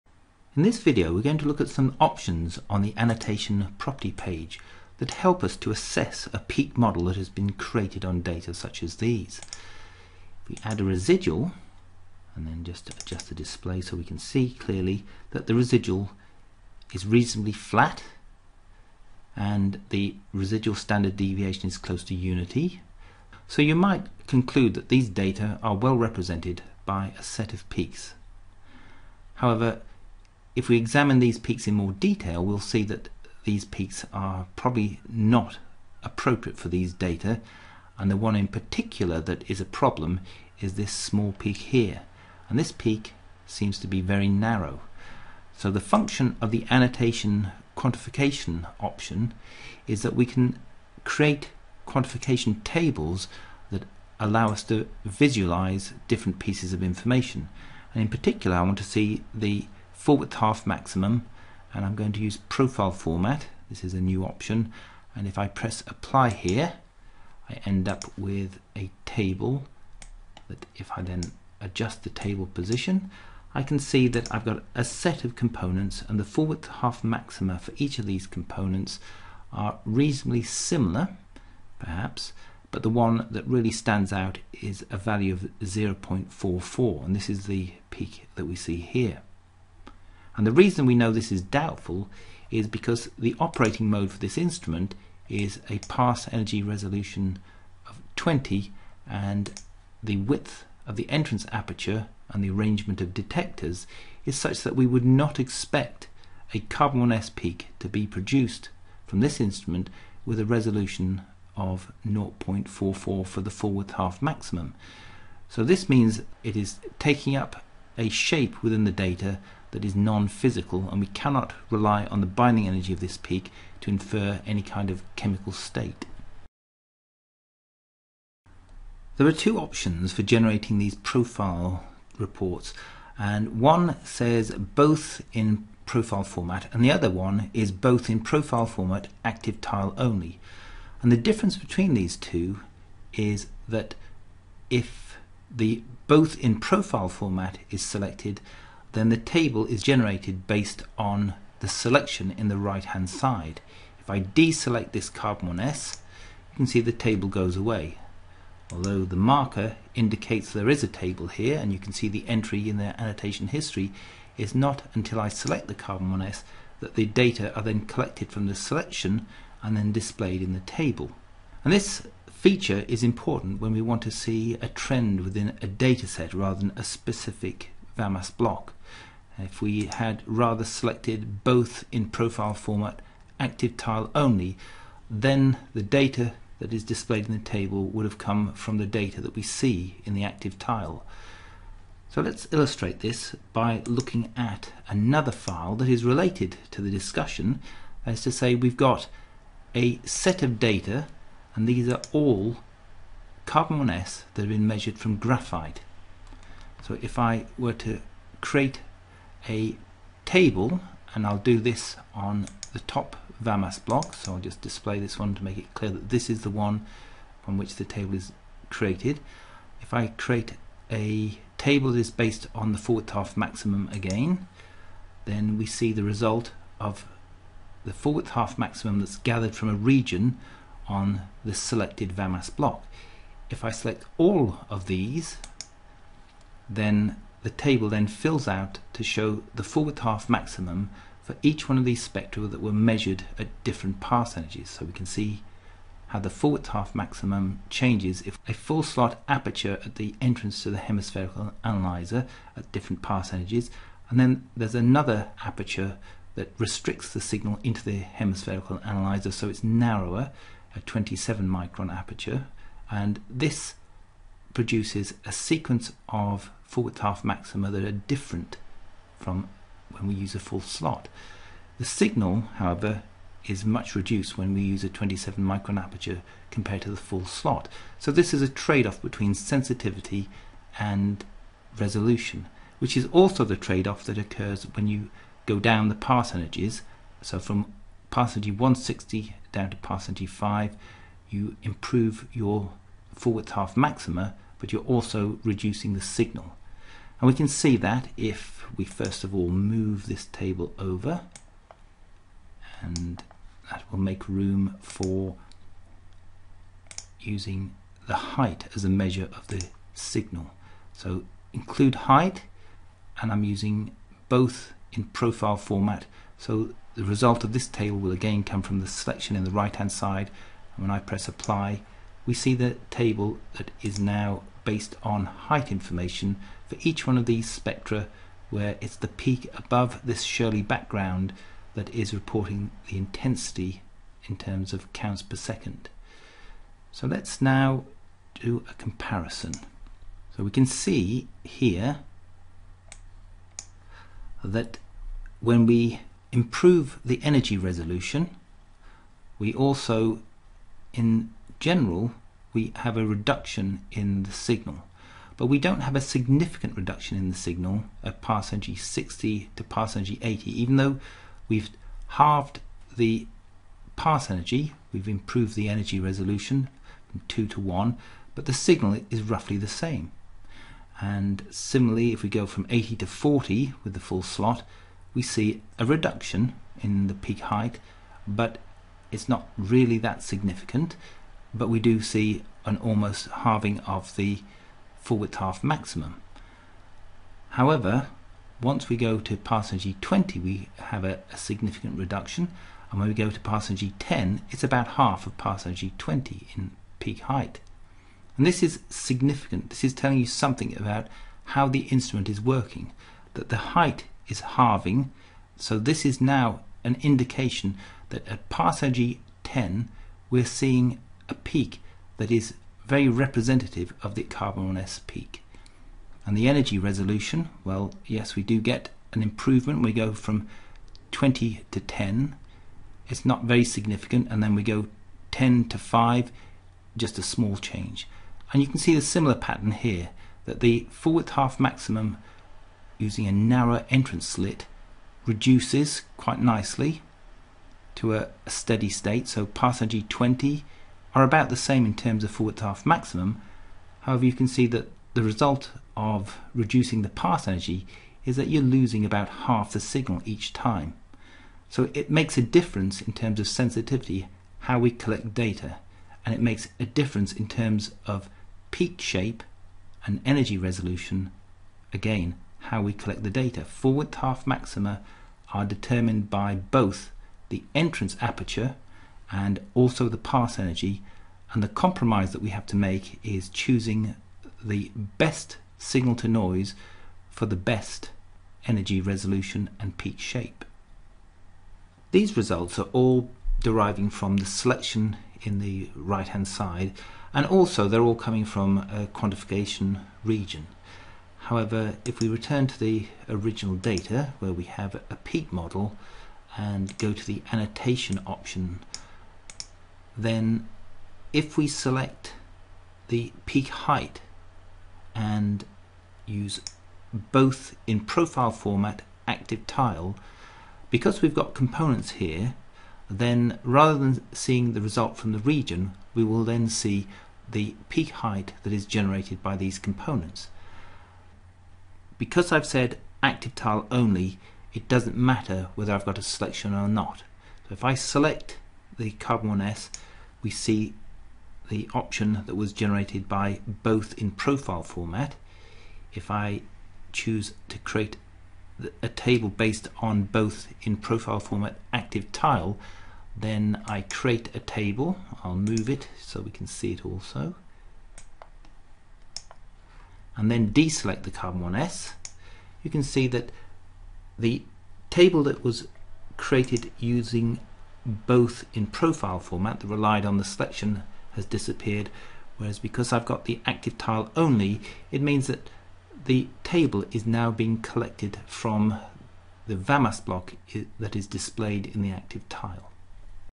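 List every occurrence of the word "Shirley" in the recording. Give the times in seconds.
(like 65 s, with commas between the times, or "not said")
330 s.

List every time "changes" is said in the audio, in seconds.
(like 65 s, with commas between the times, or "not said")
247 s, 427 s.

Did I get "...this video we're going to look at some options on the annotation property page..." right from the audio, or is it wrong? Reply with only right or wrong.
right.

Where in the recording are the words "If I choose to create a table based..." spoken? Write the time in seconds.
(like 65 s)
536 s.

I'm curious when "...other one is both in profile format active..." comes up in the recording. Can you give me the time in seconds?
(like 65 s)
136 s.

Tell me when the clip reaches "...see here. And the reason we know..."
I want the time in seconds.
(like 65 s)
88 s.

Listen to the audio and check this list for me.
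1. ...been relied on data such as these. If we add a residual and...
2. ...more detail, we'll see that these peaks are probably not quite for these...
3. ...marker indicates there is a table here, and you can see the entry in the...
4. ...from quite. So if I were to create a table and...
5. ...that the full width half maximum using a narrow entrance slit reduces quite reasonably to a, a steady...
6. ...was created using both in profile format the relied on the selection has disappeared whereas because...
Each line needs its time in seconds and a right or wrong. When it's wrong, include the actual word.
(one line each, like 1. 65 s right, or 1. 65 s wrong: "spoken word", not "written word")
1. 7 s wrong: "created", not "relied"
2. 31 s wrong: "appropriate", not "quite"
3. 159 s right
4. 204 s wrong: "graphite", not "quite"
5. 430 s wrong: "nicely", not "reasonably"
6. 555 s right.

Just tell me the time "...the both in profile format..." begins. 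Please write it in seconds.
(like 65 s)
145 s.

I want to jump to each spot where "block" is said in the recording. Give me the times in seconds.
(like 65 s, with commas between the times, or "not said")
178 s, 213 s, 232 s, 570 s.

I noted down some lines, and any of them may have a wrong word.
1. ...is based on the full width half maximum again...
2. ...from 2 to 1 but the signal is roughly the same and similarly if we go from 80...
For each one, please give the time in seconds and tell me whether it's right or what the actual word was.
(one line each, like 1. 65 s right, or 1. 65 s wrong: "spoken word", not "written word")
1. 221 s right
2. 367 s right.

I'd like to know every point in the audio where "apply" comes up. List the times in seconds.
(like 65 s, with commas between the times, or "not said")
65 s, 321 s.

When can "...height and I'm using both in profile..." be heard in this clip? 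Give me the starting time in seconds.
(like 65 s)
312 s.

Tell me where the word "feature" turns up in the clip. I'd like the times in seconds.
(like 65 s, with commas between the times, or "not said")
172 s.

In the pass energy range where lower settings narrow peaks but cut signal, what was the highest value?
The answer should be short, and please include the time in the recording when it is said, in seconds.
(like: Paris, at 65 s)
160, at 288 s.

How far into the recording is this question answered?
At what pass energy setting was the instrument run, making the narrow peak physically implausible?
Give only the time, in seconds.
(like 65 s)
95 s.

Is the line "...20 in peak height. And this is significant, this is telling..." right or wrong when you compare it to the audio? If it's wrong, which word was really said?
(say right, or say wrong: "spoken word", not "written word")
right.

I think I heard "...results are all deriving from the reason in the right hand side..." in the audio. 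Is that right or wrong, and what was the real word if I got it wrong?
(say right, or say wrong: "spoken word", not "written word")
wrong: "selection", not "reason".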